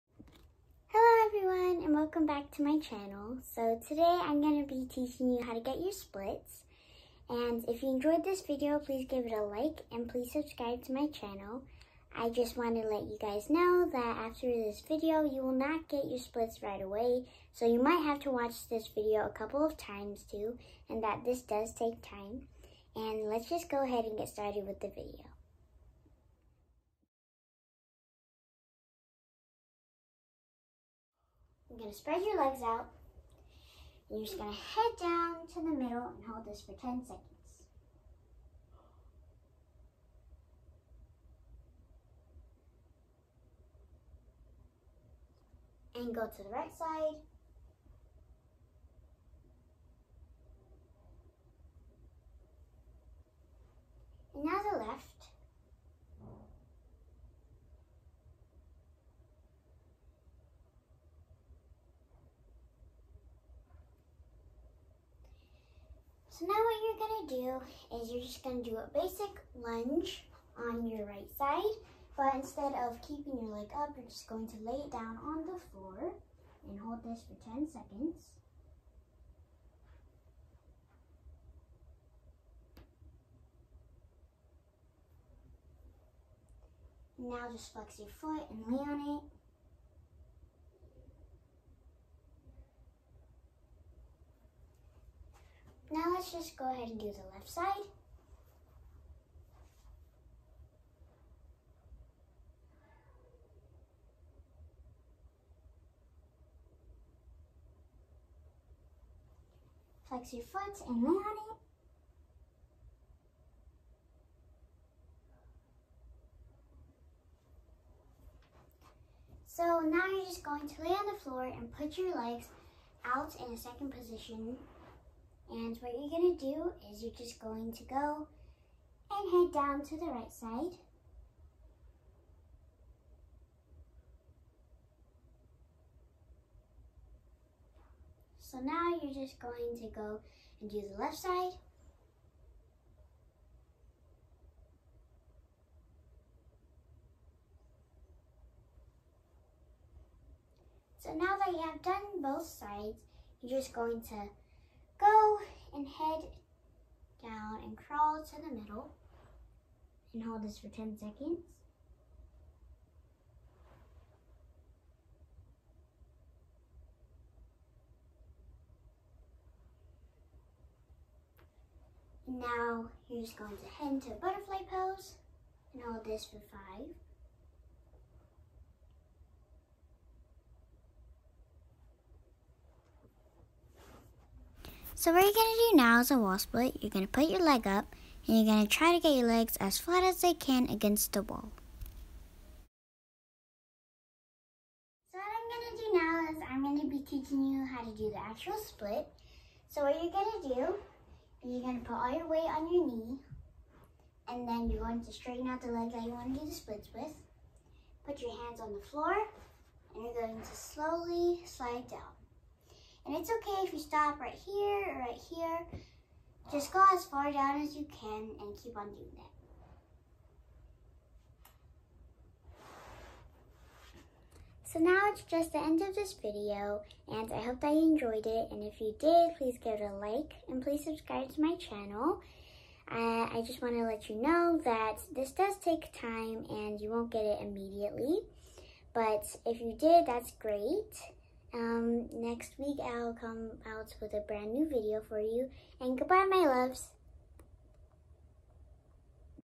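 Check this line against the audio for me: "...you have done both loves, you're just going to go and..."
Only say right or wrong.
wrong.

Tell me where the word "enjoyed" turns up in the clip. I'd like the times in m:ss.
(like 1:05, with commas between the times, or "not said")
0:07, 3:47.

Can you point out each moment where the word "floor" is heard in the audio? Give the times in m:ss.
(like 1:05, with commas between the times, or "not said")
1:15, 2:01, 3:28.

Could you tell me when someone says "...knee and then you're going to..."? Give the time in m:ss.
3:22.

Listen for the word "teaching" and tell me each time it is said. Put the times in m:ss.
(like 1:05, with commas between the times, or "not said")
0:04, 3:17.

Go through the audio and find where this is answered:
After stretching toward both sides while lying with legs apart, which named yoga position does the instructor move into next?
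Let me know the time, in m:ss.
2:54.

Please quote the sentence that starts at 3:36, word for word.
Just go as far down as you can and keep on doing that.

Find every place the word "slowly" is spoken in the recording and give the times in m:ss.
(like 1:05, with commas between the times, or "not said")
3:30.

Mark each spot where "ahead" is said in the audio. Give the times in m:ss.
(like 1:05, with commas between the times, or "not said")
0:23, 1:36.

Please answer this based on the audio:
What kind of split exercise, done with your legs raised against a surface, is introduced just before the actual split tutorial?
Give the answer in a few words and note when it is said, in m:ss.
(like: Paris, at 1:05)
wall split, at 3:06.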